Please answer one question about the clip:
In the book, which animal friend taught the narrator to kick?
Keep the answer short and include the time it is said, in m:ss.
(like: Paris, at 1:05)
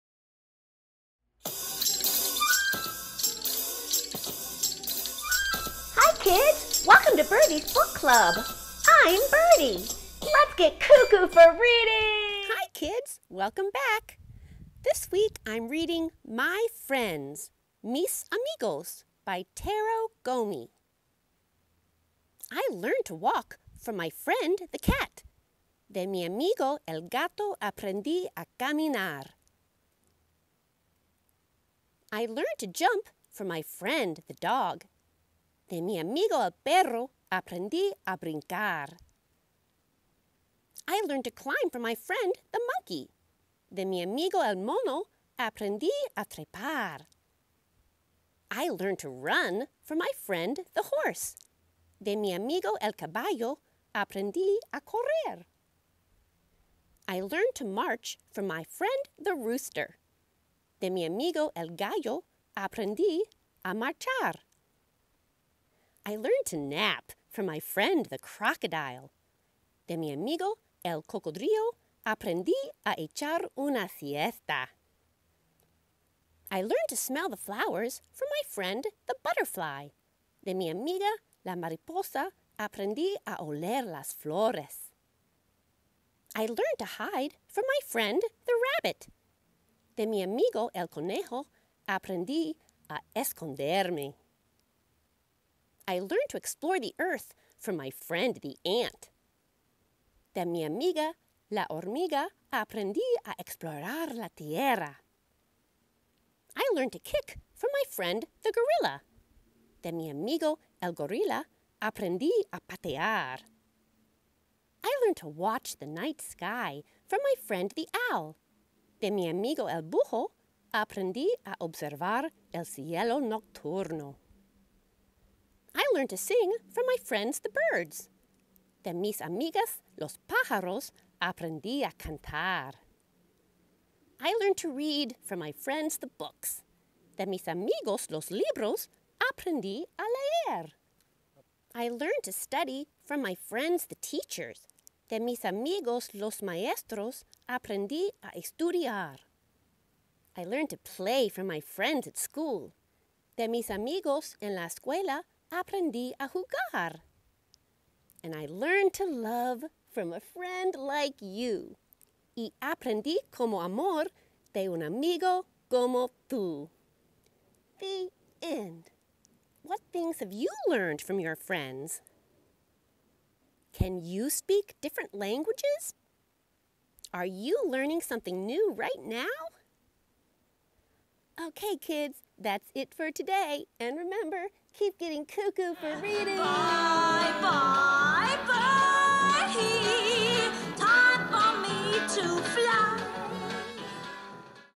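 Gorilla, at 1:48.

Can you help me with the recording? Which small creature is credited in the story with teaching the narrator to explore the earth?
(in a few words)
Ant.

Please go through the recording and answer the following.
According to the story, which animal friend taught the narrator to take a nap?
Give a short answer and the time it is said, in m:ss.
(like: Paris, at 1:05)
Crocodile, at 1:08.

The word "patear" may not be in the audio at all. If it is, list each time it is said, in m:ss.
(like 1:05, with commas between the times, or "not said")
1:52.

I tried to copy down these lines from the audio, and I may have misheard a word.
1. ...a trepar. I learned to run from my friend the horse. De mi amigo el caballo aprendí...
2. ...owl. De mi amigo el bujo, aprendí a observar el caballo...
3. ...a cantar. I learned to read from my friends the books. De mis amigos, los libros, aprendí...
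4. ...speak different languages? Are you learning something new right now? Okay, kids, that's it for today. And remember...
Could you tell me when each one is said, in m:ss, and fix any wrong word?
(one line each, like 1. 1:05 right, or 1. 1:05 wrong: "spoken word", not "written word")
1. 0:46 right
2. 1:58 wrong: "cielo", not "caballo"
3. 2:11 right
4. 2:54 right.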